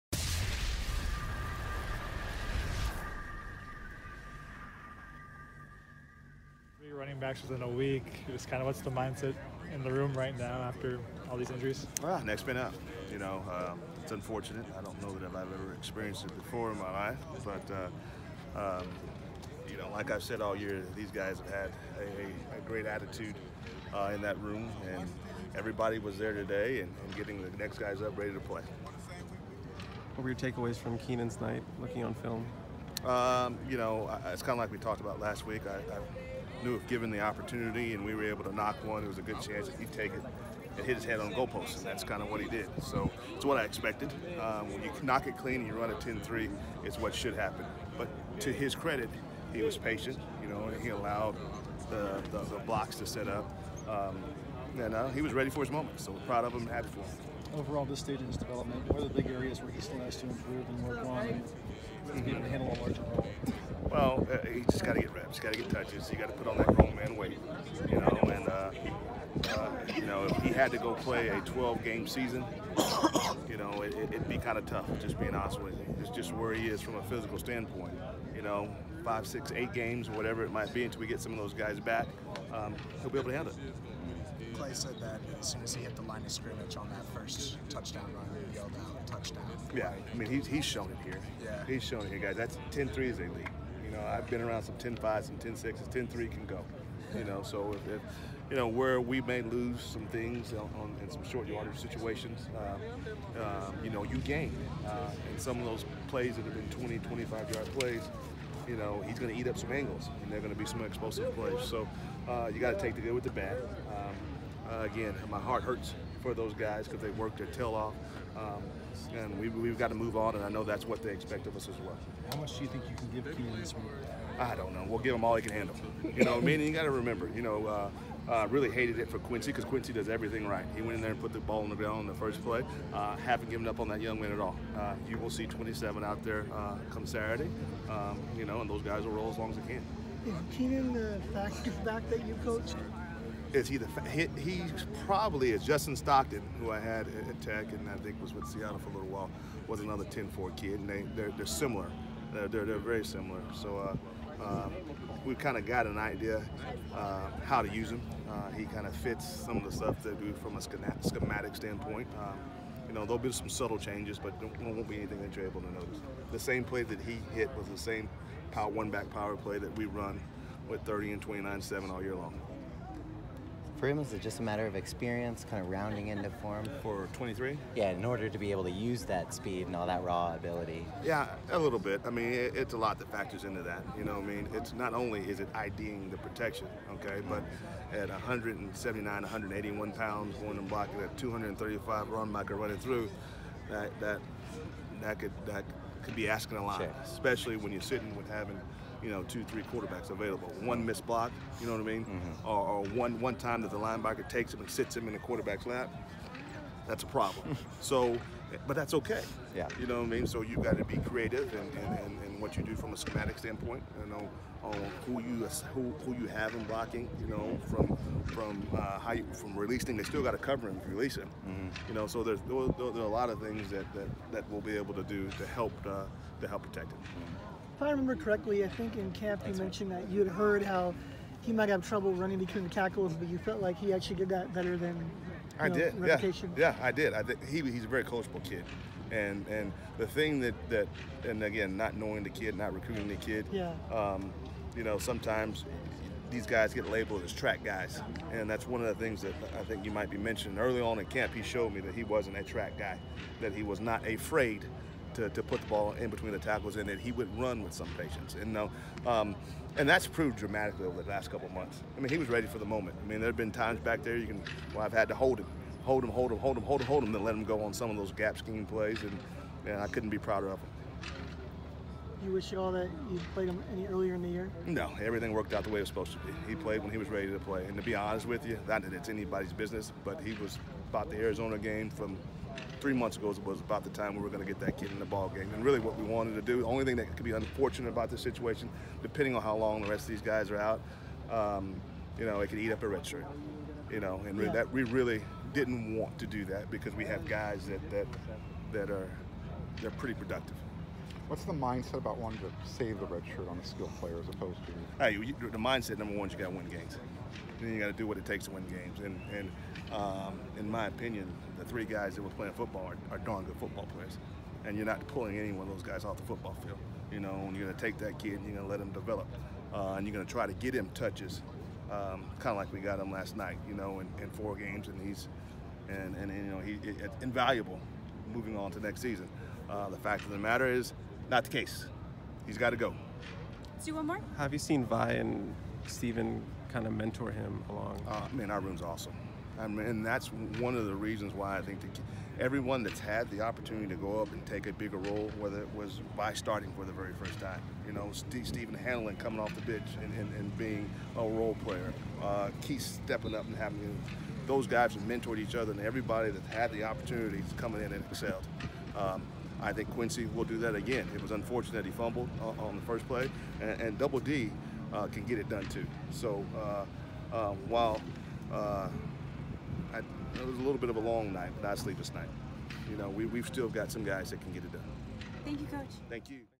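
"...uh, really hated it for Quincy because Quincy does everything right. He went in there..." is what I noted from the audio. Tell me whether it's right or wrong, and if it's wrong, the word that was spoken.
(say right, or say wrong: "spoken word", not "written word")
right.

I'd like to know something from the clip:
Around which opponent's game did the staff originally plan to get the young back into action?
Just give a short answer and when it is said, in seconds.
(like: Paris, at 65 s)
Arizona, at 281 s.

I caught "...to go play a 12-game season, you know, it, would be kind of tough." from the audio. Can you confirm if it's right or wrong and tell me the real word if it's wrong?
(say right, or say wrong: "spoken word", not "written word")
right.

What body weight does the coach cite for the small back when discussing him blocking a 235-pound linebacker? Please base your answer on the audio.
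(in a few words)
179.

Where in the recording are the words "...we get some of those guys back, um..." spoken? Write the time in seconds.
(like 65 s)
81 s.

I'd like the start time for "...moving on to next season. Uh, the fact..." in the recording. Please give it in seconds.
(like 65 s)
328 s.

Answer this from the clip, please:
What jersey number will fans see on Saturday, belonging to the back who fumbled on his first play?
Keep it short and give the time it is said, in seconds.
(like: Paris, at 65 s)
27, at 135 s.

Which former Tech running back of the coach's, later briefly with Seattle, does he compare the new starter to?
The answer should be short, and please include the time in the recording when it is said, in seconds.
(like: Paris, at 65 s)
Justin Stockton, at 145 s.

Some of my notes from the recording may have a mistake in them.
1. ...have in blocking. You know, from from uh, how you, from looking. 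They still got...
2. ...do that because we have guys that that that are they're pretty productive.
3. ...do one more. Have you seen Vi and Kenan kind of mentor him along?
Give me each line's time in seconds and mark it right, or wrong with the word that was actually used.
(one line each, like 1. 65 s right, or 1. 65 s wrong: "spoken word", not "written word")
1. 216 s wrong: "releasing", not "looking"
2. 296 s right
3. 333 s wrong: "Steven", not "Kenan".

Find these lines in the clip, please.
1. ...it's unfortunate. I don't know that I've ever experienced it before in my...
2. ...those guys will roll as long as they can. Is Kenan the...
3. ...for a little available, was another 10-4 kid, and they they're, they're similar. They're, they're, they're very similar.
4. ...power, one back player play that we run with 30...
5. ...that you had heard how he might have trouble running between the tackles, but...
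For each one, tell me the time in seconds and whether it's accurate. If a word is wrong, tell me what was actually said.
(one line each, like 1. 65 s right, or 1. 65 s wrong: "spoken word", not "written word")
1. 14 s right
2. 138 s right
3. 148 s wrong: "while", not "available"
4. 168 s wrong: "power", not "player"
5. 229 s right.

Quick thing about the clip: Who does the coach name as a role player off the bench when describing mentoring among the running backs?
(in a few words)
Stephen Hanlon.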